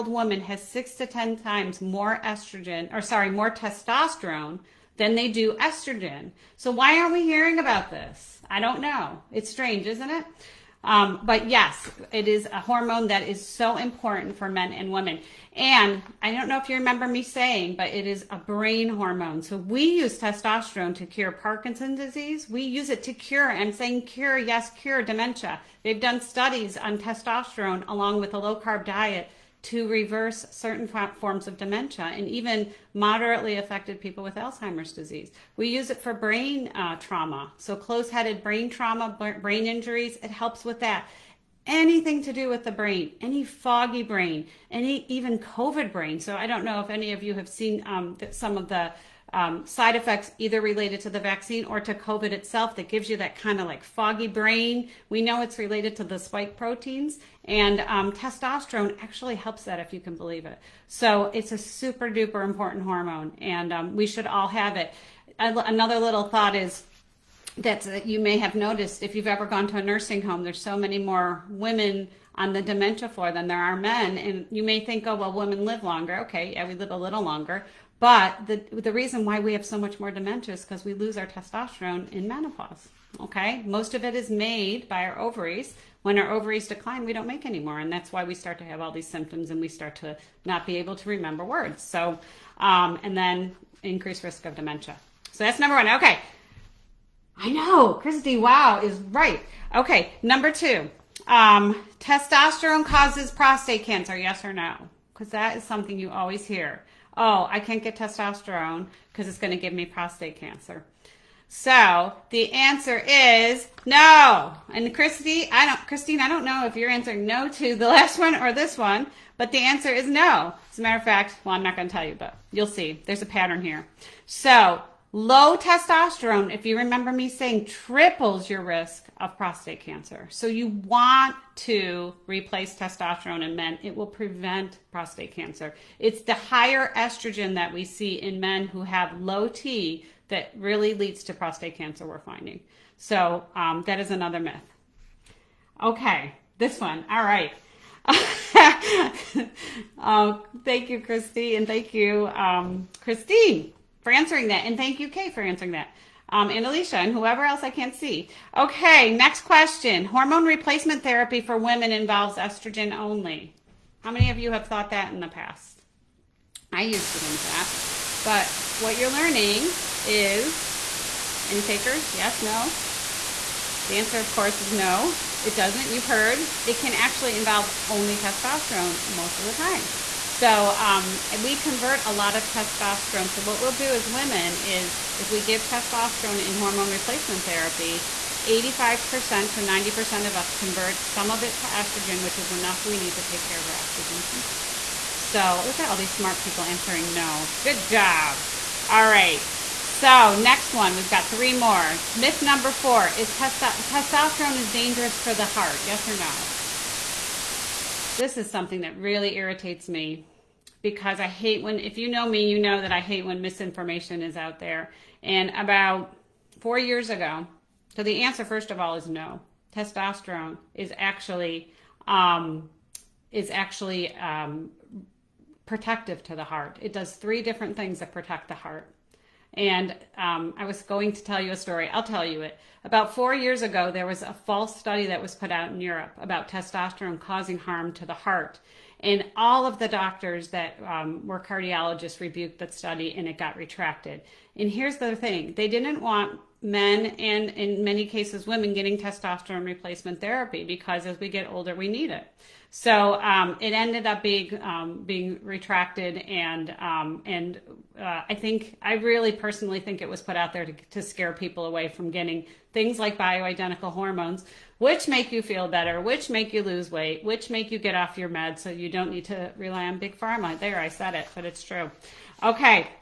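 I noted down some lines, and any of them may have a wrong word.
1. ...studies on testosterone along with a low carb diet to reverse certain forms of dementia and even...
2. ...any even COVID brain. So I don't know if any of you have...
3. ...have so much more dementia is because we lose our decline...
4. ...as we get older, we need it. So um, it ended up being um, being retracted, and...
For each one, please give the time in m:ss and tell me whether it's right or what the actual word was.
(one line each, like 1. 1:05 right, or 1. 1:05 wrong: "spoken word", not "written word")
1. 0:26 right
2. 0:44 right
3. 1:19 wrong: "testosterone", not "decline"
4. 4:11 right.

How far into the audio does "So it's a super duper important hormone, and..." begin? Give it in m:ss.
1:00.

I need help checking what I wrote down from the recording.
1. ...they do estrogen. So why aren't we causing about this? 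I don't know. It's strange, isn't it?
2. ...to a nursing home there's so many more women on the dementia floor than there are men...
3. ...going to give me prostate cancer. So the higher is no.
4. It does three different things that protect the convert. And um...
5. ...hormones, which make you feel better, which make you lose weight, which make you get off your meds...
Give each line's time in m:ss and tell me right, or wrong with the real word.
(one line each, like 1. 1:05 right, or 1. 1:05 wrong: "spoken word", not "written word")
1. 0:05 wrong: "hearing", not "causing"
2. 1:09 right
3. 1:49 wrong: "answer", not "higher"
4. 3:46 wrong: "heart", not "convert"
5. 4:23 right.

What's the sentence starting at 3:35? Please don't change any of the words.
And about four years ago, so the answer, first of all, is no.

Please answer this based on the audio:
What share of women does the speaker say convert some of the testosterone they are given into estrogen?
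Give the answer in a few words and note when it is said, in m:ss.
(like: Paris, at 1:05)
85% to 90%, at 3:08.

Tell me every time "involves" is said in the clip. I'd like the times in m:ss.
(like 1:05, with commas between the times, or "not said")
2:41, 2:57.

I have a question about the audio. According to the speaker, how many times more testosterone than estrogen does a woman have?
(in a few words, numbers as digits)
6 to 10 times.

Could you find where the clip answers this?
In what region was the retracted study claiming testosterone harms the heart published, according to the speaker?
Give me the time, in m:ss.
3:55.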